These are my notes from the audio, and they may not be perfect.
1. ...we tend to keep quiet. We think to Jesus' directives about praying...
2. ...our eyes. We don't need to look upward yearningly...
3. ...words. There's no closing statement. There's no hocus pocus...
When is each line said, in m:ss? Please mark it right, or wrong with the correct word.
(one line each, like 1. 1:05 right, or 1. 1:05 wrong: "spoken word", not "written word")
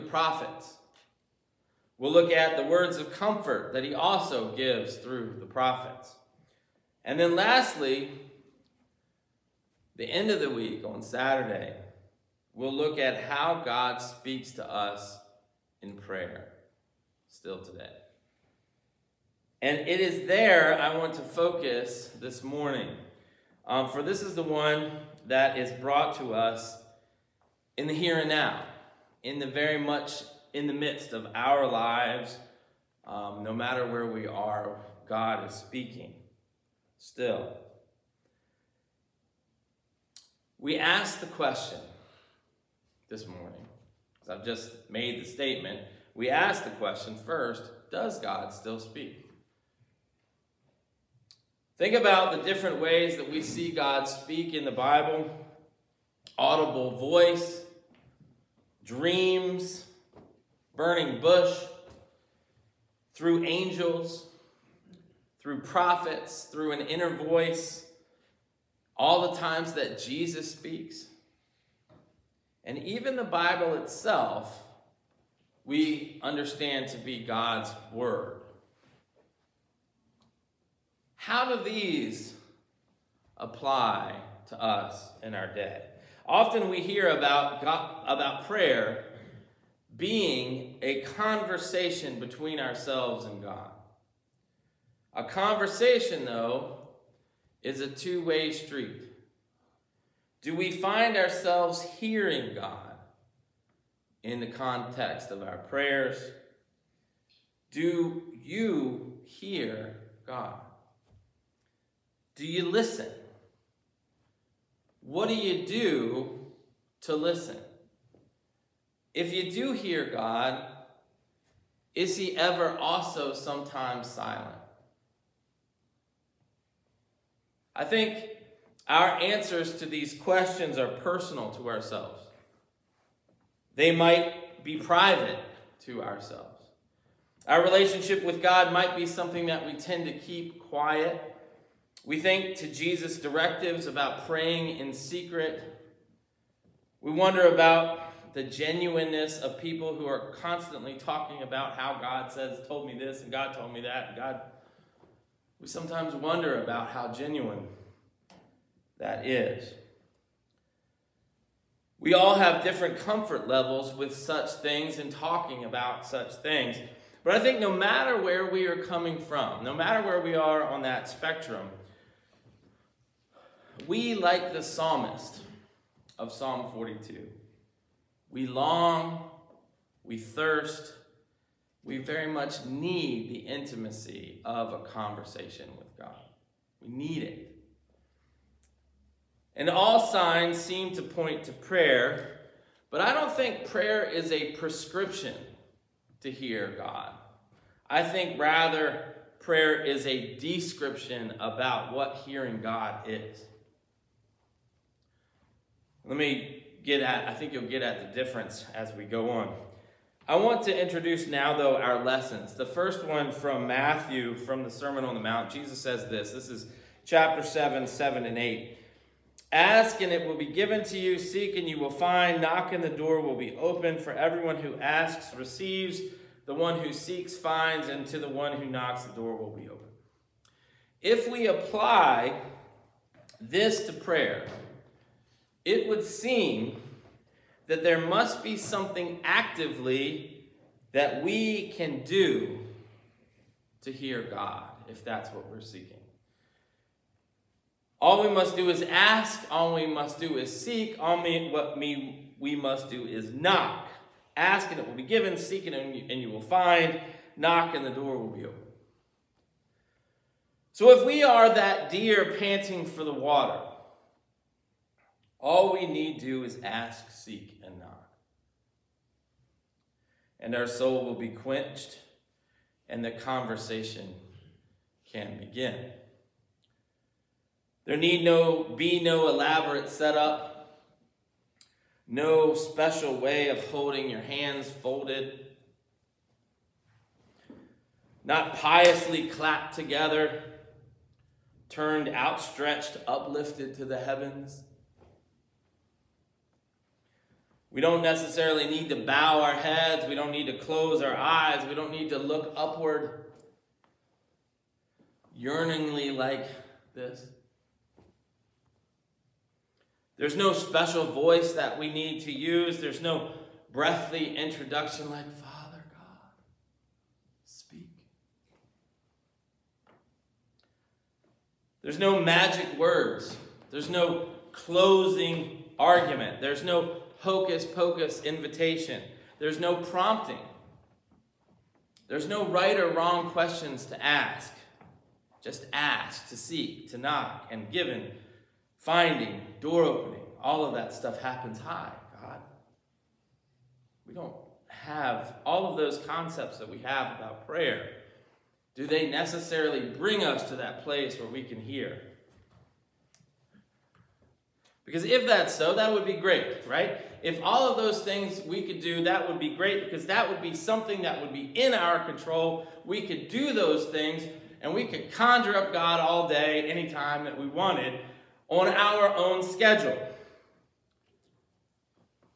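1. 2:19 right
2. 5:01 right
3. 5:22 wrong: "argument", not "statement".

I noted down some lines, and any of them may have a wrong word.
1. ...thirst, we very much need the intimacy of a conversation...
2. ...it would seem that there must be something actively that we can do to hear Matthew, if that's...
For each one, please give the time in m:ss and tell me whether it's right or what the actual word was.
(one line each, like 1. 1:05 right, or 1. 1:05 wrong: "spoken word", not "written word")
1. 3:00 right
2. 3:55 wrong: "God", not "Matthew".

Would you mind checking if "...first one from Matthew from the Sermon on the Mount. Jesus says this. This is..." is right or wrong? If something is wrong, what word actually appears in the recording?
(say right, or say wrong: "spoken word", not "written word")
right.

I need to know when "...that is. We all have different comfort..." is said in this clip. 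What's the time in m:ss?
2:38.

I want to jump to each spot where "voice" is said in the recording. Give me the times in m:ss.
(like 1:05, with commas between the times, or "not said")
0:56, 1:07, 5:11.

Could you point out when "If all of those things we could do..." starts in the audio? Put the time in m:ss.
5:57.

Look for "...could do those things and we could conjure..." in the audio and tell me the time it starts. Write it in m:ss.
6:03.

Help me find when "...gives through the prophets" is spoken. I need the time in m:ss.
0:04.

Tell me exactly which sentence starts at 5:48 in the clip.
Do they necessarily bring us to that place where we can hear?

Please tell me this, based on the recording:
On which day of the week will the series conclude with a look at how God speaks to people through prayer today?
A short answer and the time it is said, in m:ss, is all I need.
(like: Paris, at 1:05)
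Saturday, at 0:11.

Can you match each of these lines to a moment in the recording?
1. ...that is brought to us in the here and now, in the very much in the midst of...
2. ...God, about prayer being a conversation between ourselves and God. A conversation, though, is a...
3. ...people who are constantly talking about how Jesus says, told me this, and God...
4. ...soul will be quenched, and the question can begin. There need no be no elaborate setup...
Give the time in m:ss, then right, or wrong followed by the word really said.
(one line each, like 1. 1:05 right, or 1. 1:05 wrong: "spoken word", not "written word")
1. 0:25 right
2. 1:27 right
3. 2:29 wrong: "God", not "Jesus"
4. 4:30 wrong: "conversation", not "question".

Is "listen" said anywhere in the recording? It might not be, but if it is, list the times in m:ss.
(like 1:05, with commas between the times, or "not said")
1:52, 1:57.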